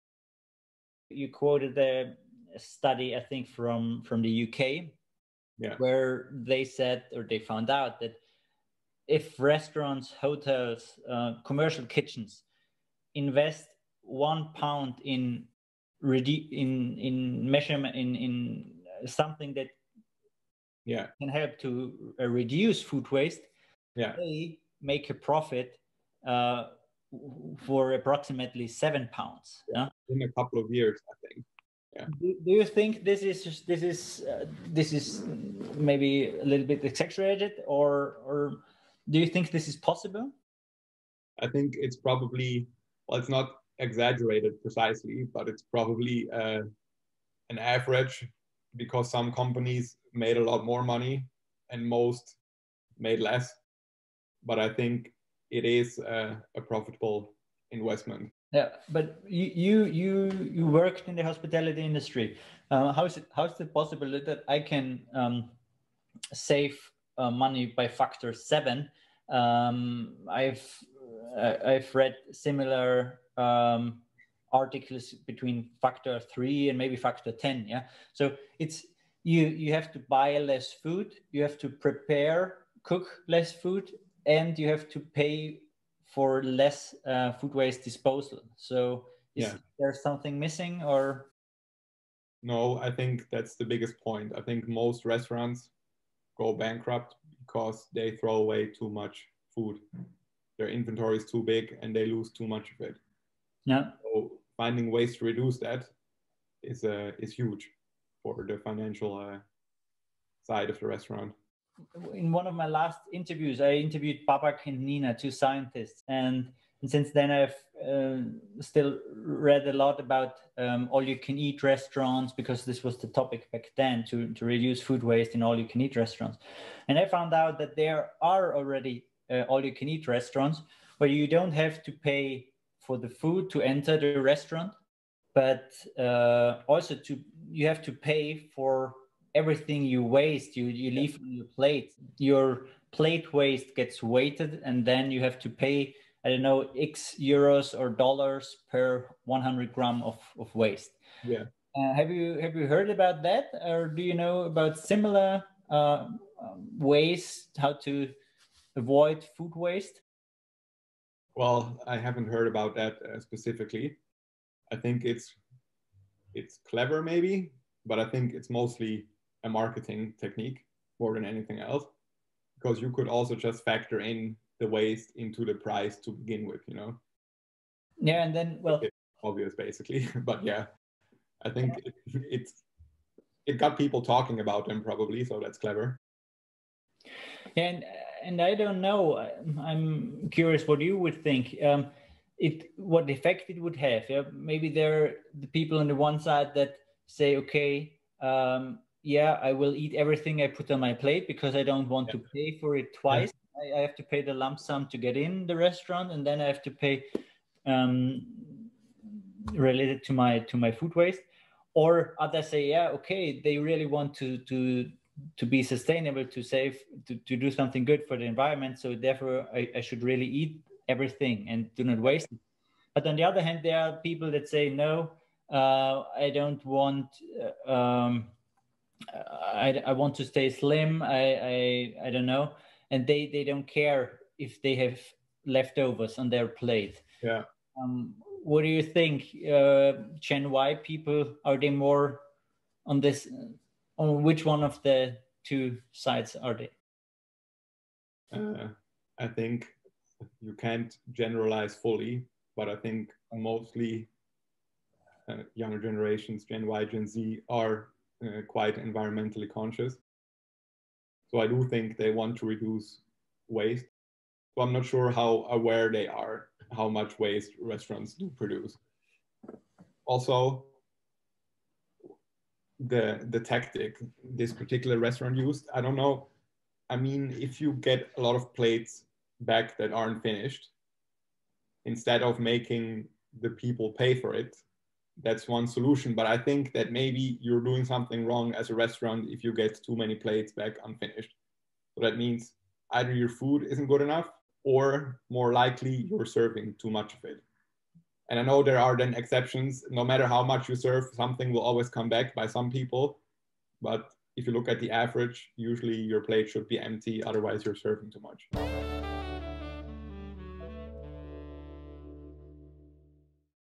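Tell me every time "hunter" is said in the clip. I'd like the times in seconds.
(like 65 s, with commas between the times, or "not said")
not said.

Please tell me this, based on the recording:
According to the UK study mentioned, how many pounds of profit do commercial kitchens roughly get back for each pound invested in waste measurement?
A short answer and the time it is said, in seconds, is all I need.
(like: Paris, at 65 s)
7, at 28 s.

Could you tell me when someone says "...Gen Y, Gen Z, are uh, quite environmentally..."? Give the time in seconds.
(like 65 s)
256 s.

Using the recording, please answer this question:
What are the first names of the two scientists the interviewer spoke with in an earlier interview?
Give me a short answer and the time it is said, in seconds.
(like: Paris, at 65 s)
Babak and Nina, at 114 s.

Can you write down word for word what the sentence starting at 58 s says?
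Yeah, but you you you, worked in the hospitality industry.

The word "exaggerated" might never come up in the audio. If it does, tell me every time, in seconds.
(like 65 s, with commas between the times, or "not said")
36 s, 43 s.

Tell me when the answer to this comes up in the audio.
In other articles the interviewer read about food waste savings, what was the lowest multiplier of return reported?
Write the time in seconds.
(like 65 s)
75 s.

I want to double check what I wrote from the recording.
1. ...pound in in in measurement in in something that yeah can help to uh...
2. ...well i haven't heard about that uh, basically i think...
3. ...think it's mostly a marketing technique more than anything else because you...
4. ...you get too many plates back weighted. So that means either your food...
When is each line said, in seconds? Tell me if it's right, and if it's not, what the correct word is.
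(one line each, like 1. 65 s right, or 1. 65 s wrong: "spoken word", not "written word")
1. 14 s right
2. 161 s wrong: "specifically", not "basically"
3. 168 s right
4. 289 s wrong: "unfinished", not "weighted".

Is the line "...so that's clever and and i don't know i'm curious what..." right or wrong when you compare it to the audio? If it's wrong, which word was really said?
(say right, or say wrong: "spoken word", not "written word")
right.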